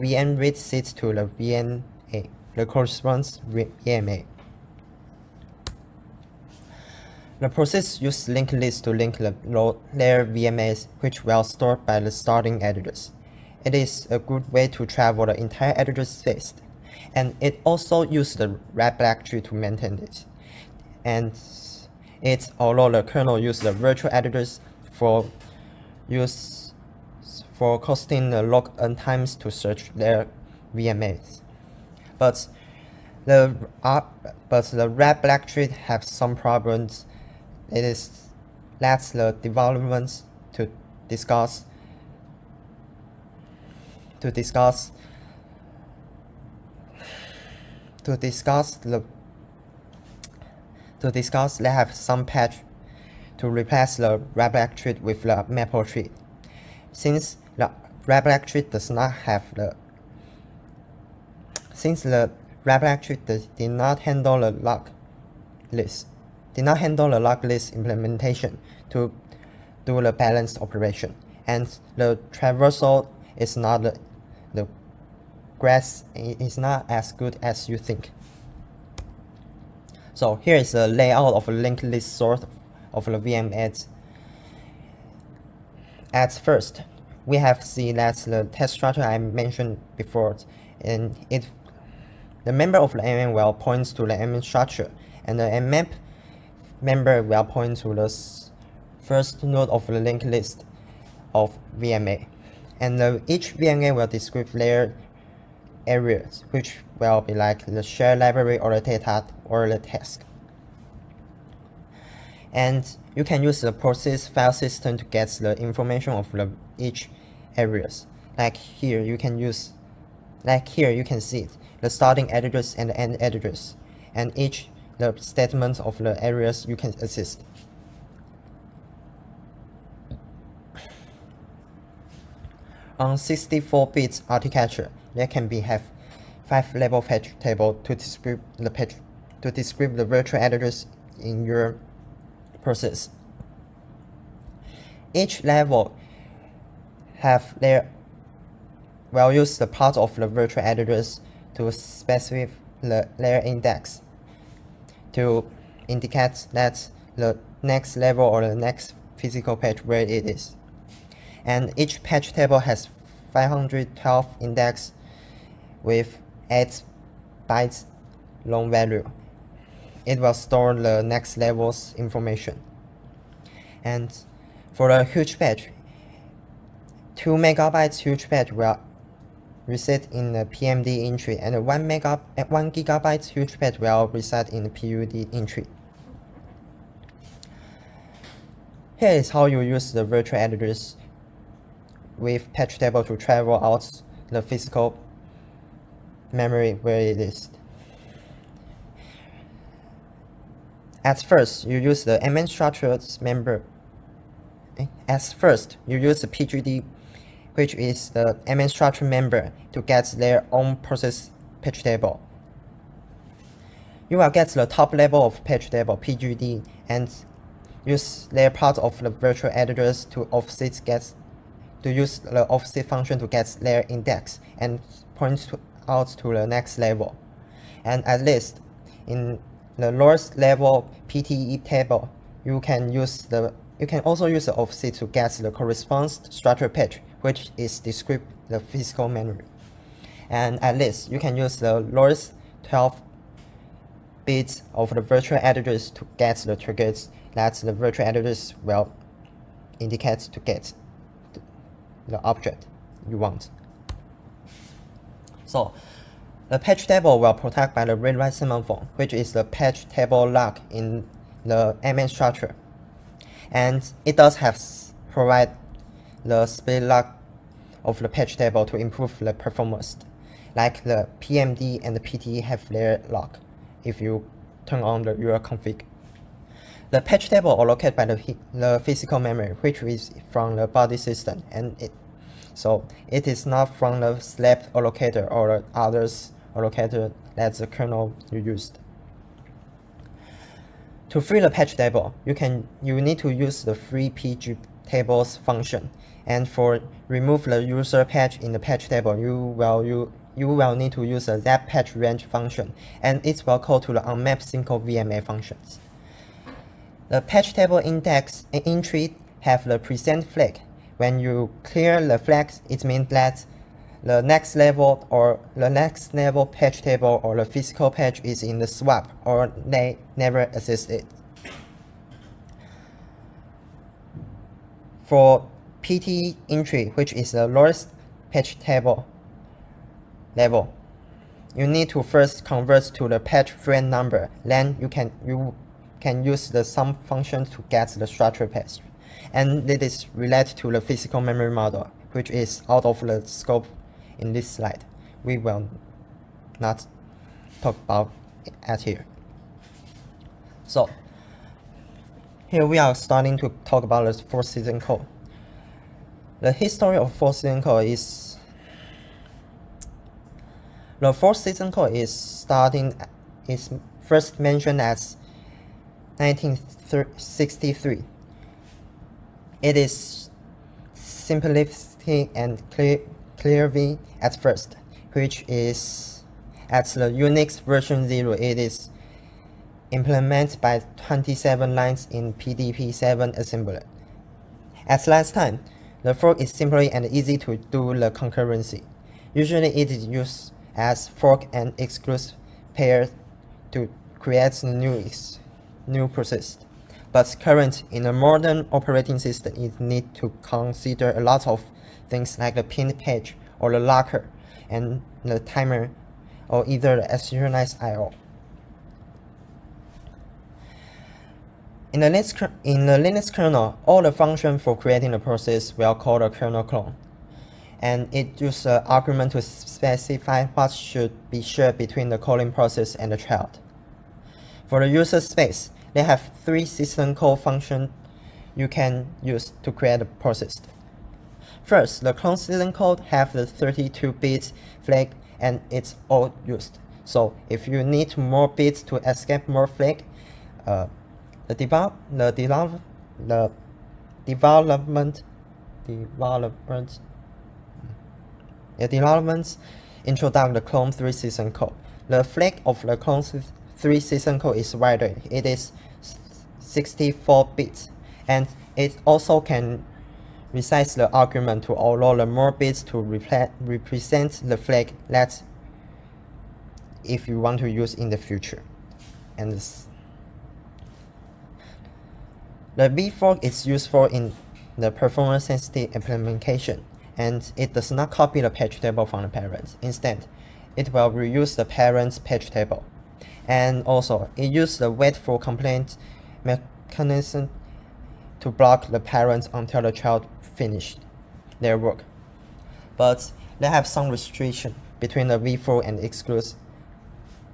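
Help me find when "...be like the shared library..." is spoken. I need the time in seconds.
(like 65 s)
107 s.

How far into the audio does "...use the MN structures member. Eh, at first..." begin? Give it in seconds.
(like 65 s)
201 s.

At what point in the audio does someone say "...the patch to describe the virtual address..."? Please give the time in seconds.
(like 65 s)
138 s.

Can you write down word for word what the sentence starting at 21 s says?
And it, although the kernel uses the virtual addresses for use for costing the log n times to search their VMAs.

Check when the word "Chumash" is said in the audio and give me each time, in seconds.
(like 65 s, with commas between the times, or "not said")
not said.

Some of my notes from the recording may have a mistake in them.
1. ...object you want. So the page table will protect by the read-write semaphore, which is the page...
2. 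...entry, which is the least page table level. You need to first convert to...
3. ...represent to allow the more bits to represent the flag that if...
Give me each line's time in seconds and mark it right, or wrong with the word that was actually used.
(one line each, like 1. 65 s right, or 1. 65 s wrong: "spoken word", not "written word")
1. 252 s right
2. 326 s wrong: "lowest", not "least"
3. 461 s wrong: "argument", not "represent".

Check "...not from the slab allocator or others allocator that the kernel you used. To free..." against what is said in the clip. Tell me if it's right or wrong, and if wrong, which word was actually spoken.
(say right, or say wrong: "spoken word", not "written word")
right.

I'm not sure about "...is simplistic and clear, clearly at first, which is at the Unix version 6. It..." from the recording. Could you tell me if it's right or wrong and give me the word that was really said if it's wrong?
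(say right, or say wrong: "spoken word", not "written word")
wrong: "0", not "6".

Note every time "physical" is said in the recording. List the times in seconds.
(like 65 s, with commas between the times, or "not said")
159 s, 194 s, 238 s, 278 s, 317 s, 340 s.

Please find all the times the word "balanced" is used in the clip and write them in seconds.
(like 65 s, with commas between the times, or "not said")
70 s.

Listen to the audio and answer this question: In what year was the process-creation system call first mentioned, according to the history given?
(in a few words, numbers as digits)
1963.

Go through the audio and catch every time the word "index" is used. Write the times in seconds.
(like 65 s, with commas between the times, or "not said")
153 s, 164 s, 223 s, 307 s.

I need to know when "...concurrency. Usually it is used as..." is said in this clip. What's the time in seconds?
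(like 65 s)
388 s.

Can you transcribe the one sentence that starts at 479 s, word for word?
Instead, it will reuse the parent's page table.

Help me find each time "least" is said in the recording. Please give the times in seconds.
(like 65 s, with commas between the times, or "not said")
228 s, 240 s.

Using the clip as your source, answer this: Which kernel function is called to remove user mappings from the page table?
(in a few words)
zap page range.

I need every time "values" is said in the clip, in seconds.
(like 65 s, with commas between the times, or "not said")
149 s, 168 s.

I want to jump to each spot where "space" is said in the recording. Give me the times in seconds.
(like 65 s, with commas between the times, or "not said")
16 s, 425 s.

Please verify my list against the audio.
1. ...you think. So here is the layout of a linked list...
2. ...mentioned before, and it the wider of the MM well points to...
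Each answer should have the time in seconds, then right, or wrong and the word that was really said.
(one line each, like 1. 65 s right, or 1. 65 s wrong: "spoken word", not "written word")
1. 77 s right
2. 89 s wrong: "member", not "wider".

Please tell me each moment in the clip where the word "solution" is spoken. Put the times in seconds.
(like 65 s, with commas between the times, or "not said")
not said.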